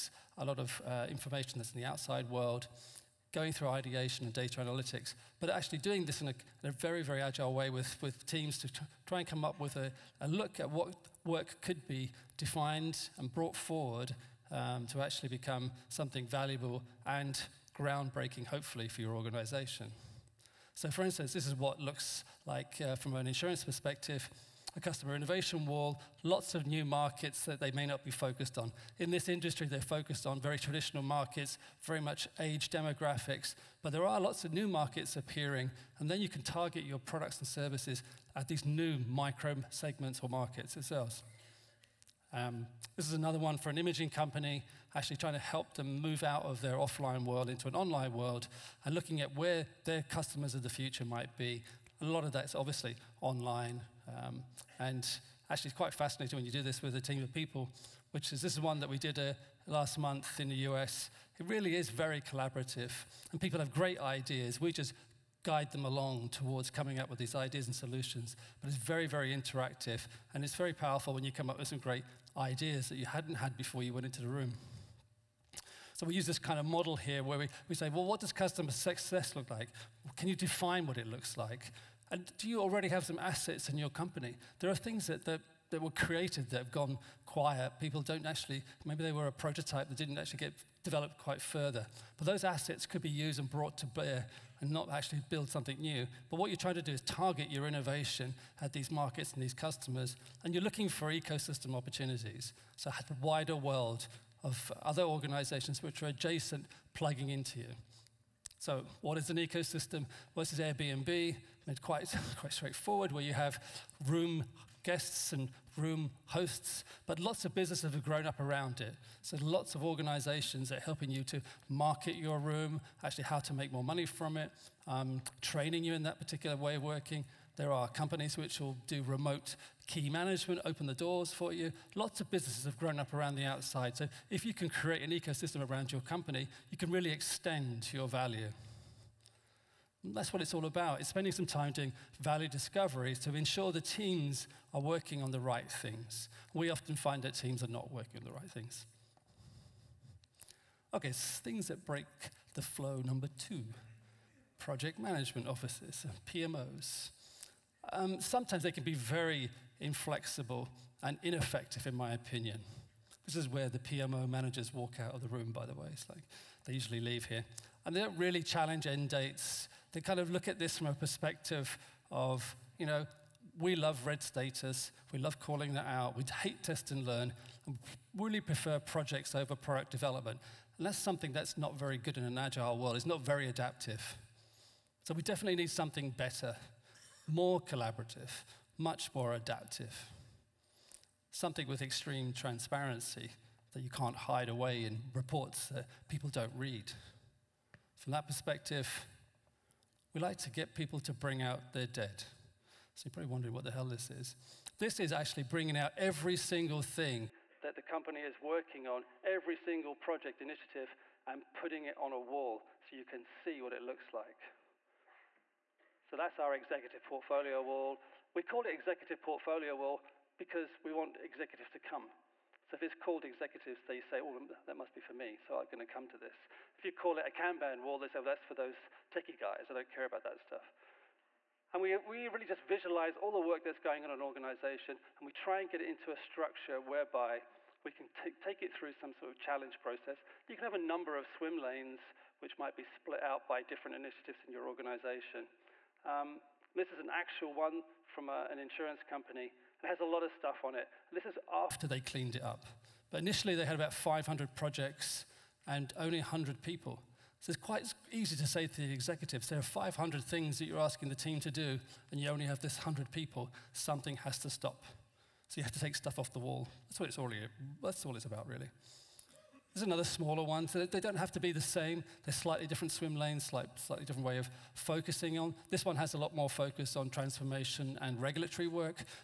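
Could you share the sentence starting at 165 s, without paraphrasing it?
It's like they usually leave here.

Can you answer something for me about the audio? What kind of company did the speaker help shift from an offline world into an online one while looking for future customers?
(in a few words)
Imaging company.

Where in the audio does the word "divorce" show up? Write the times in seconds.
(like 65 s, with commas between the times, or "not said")
not said.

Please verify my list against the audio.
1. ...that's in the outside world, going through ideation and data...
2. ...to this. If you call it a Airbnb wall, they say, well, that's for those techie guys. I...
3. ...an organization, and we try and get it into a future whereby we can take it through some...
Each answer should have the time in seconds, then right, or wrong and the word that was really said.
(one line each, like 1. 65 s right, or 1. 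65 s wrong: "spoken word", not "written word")
1. 1 s right
2. 226 s wrong: "Kanban", not "Airbnb"
3. 234 s wrong: "structure", not "future".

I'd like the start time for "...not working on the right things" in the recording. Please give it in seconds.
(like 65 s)
147 s.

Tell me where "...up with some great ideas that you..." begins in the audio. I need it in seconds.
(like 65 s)
71 s.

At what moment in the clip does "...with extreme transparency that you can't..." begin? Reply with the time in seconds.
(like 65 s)
191 s.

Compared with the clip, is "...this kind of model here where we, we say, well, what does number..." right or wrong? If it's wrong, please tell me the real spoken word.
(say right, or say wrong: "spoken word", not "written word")
wrong: "customer", not "number".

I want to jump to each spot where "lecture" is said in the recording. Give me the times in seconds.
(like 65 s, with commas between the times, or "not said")
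not said.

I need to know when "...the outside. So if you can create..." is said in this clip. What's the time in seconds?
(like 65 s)
133 s.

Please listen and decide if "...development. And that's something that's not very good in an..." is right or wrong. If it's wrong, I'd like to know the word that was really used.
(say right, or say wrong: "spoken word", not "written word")
right.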